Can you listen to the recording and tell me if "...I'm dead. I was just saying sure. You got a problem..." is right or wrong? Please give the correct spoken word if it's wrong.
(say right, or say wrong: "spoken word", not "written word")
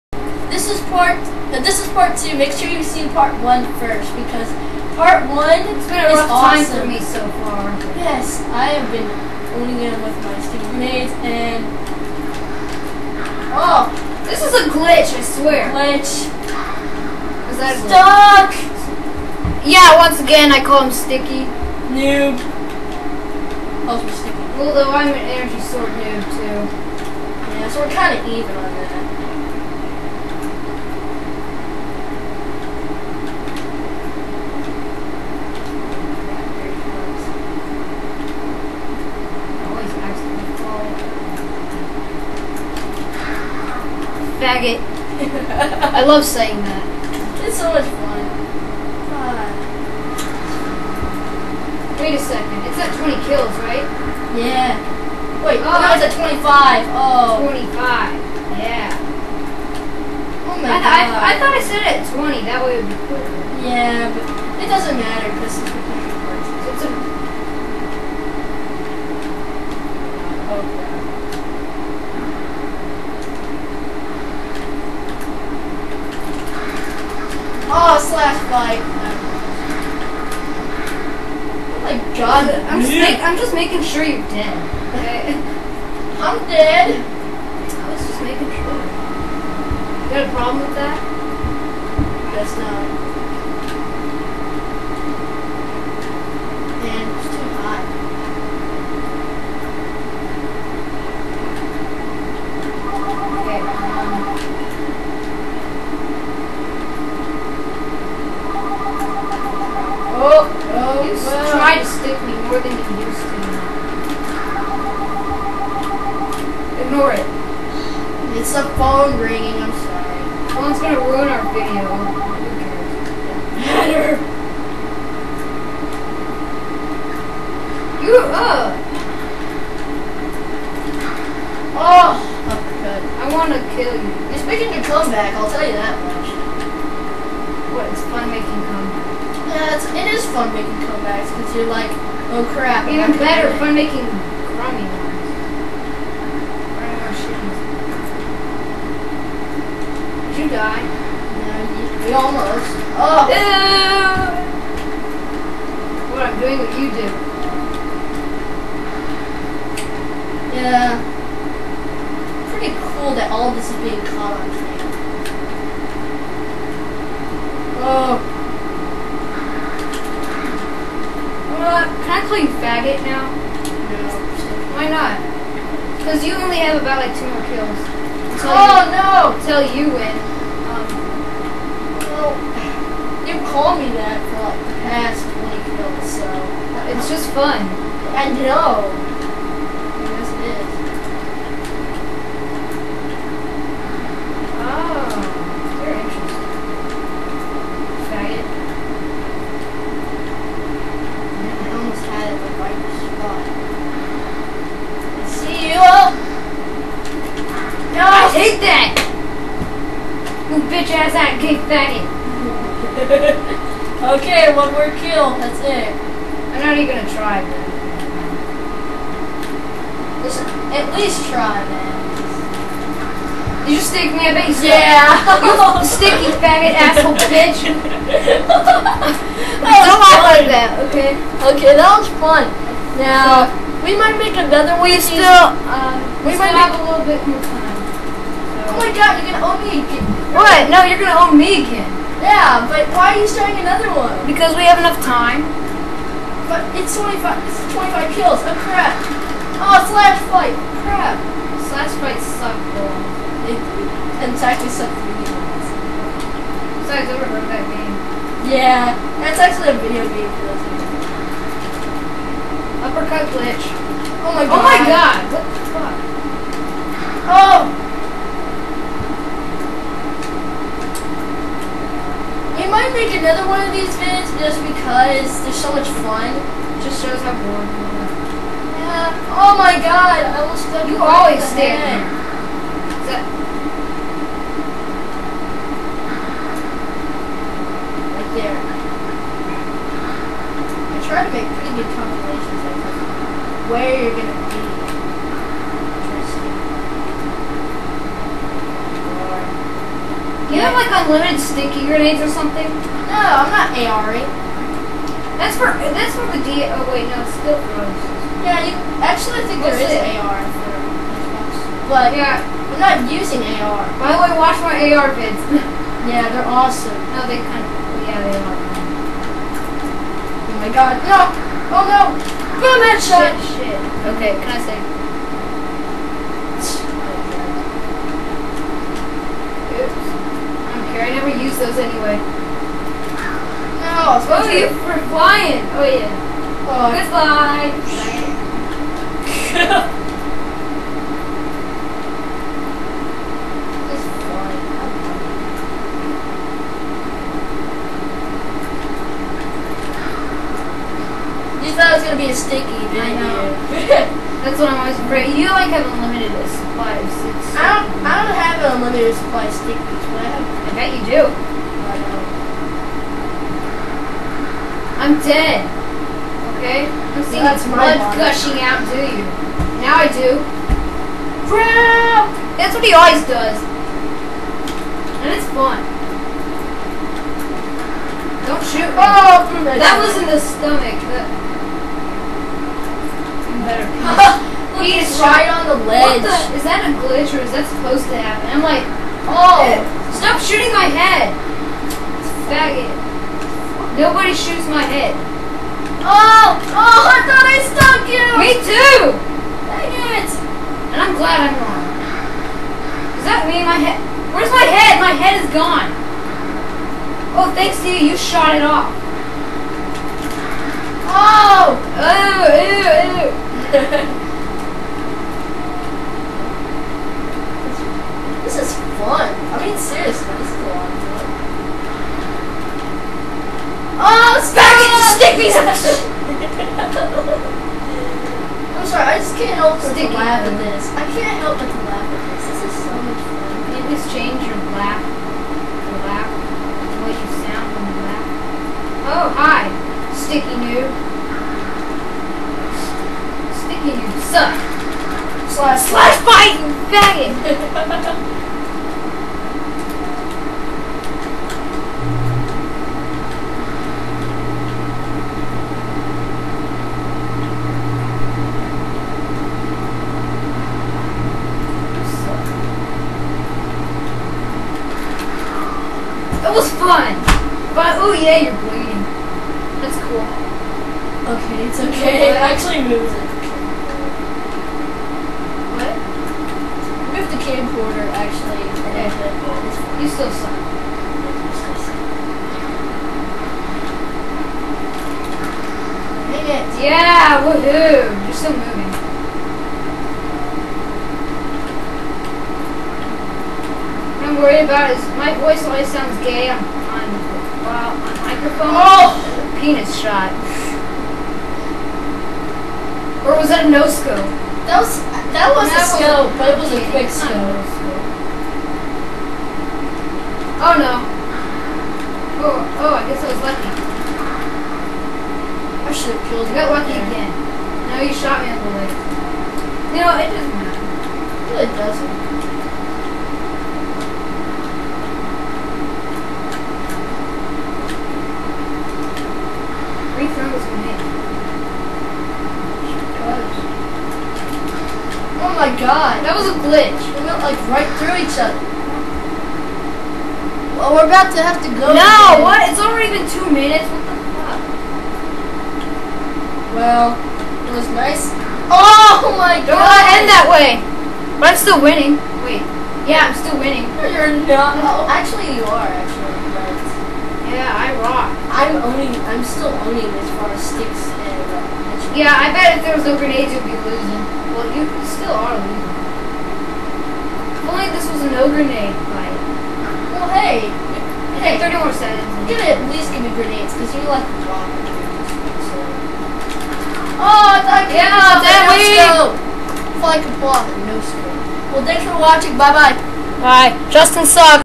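wrong: "making", not "saying".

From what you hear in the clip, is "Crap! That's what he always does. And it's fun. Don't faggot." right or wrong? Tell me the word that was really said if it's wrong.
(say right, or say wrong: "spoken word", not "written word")
wrong: "shoot", not "faggot".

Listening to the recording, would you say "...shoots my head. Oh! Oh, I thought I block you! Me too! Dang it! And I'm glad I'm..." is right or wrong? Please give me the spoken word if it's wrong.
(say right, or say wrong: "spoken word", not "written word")
wrong: "stuck", not "block".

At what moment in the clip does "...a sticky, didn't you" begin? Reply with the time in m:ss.
5:52.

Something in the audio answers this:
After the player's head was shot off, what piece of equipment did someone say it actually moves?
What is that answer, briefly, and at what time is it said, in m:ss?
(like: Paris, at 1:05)
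The camcorder, at 7:57.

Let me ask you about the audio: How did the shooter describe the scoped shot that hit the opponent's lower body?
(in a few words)
Quick scope.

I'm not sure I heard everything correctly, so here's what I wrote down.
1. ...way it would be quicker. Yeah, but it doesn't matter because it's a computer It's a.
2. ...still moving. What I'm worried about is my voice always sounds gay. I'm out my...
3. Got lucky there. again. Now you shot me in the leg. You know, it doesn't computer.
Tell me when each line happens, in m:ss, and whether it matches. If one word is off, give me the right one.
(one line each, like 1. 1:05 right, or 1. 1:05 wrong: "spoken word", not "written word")
1. 1:02 right
2. 8:08 right
3. 8:36 wrong: "matter", not "computer".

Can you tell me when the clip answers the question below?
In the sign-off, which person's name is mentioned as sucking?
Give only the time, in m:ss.
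9:43.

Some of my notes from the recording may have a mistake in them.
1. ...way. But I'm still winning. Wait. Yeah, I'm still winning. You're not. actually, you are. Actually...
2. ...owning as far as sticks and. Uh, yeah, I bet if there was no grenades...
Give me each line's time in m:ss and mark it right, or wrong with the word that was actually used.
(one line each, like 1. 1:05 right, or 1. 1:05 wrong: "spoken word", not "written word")
1. 9:10 right
2. 9:19 right.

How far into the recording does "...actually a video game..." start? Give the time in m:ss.
4:19.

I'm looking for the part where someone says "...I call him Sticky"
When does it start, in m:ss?
0:20.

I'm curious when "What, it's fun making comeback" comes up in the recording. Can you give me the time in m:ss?
2:17.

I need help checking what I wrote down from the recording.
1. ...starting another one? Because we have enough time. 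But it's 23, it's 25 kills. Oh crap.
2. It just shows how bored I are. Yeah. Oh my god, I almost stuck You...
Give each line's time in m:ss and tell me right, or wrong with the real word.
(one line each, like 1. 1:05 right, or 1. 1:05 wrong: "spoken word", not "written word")
1. 4:03 wrong: "25", not "23"
2. 4:36 right.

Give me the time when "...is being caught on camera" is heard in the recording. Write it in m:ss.
2:43.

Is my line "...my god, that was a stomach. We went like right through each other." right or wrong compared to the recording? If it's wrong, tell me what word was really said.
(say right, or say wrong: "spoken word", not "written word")
wrong: "glitch", not "stomach".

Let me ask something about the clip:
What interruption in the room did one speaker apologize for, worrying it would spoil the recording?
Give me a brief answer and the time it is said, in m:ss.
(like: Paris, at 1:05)
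The phone ringing, at 1:58.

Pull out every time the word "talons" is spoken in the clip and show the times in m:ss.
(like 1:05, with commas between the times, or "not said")
not said.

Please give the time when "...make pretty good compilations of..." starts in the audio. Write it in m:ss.
4:51.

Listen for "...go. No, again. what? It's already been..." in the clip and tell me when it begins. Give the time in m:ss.
9:01.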